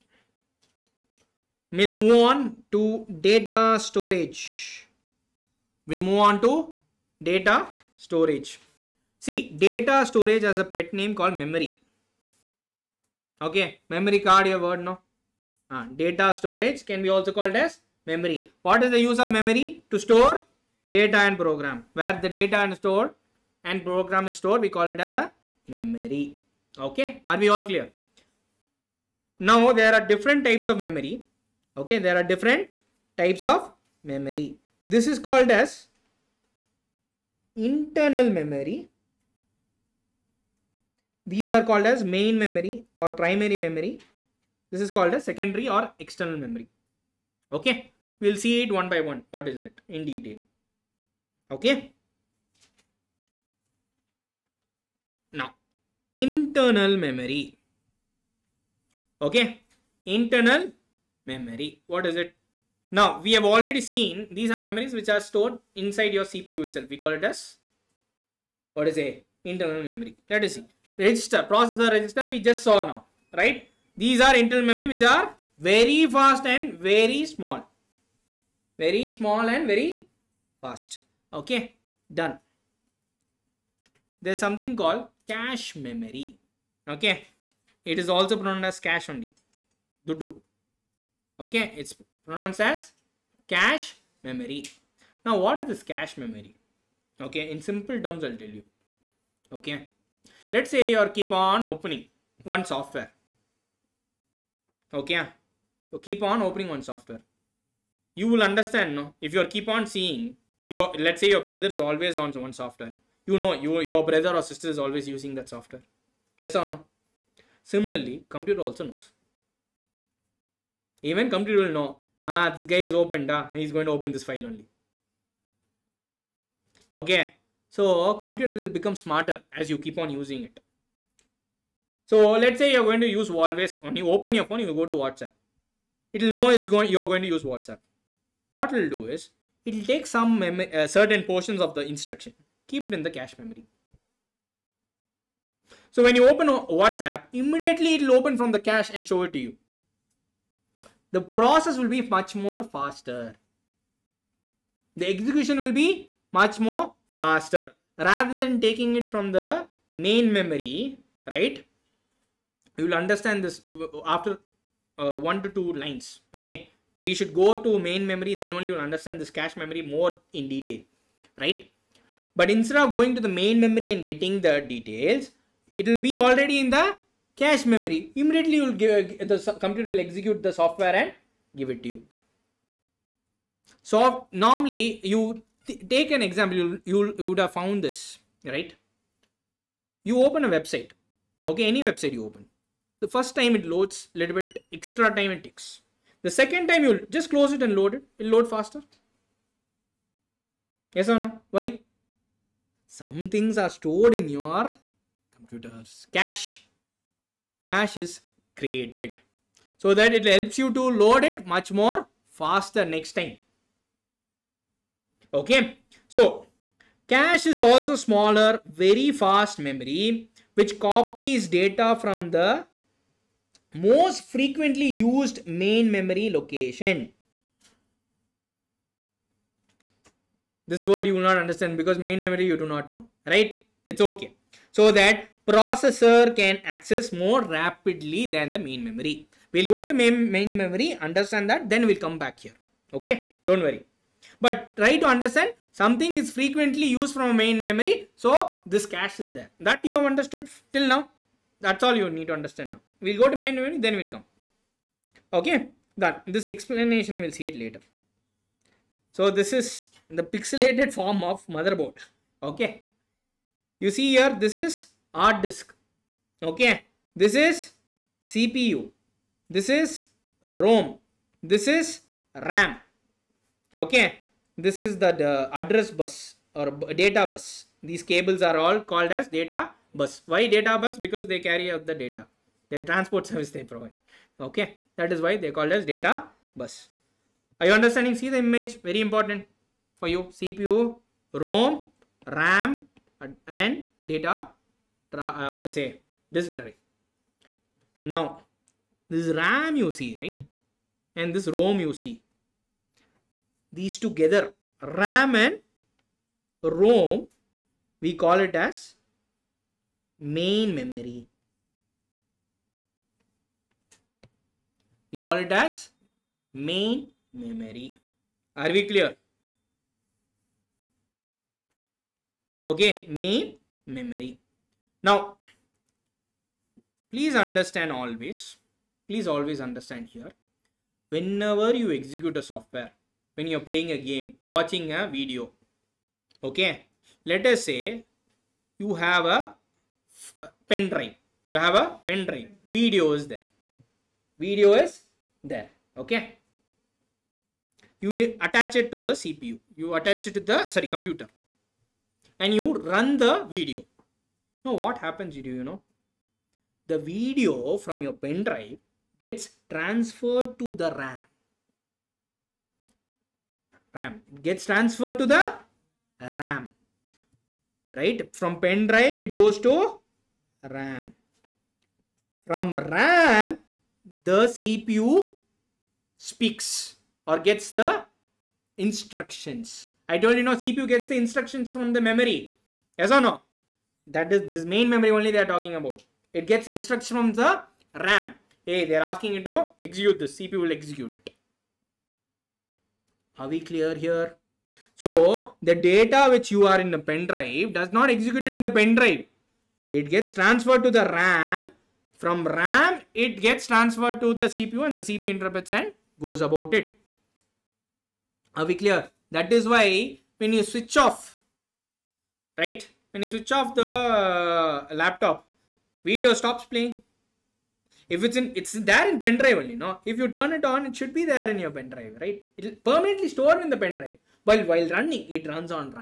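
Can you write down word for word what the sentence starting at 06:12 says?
From RAM, the CPU speaks or gets the instructions.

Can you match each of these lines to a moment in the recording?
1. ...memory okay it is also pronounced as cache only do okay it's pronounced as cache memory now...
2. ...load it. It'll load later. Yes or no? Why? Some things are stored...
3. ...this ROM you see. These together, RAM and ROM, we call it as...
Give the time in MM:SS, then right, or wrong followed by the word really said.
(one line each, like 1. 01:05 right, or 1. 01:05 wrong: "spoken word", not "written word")
1. 01:25 right
2. 03:17 wrong: "faster", not "later"
3. 05:01 right.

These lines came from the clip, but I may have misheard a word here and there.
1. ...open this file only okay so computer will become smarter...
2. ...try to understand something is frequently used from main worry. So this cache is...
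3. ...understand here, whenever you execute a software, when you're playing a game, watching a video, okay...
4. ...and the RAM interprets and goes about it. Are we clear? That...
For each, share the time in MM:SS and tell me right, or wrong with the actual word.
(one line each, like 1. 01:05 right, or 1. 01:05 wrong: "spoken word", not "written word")
1. 02:03 right
2. 04:04 wrong: "memory", not "worry"
3. 05:29 right
4. 06:44 wrong: "CPU", not "RAM".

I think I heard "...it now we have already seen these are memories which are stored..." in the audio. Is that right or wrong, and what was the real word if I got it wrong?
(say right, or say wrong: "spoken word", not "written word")
right.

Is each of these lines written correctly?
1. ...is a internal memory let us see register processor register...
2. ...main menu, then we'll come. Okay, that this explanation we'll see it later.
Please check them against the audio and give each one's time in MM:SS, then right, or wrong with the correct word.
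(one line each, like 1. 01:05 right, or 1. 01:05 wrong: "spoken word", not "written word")
1. 01:08 right
2. 04:13 right.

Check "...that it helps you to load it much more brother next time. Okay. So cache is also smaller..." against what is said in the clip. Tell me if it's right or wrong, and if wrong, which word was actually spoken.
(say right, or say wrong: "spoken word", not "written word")
wrong: "faster", not "brother".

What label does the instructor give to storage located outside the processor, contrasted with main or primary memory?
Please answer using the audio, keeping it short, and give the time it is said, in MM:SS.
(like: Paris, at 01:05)
Secondary or external memory, at 00:45.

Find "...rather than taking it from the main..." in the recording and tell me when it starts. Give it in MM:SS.
02:37.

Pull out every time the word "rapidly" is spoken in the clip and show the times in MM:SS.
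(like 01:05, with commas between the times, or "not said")
03:57.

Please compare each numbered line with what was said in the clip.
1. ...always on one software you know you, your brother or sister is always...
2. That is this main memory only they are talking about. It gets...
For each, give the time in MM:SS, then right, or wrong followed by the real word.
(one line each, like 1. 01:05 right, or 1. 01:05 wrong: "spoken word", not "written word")
1. 01:51 right
2. 06:24 right.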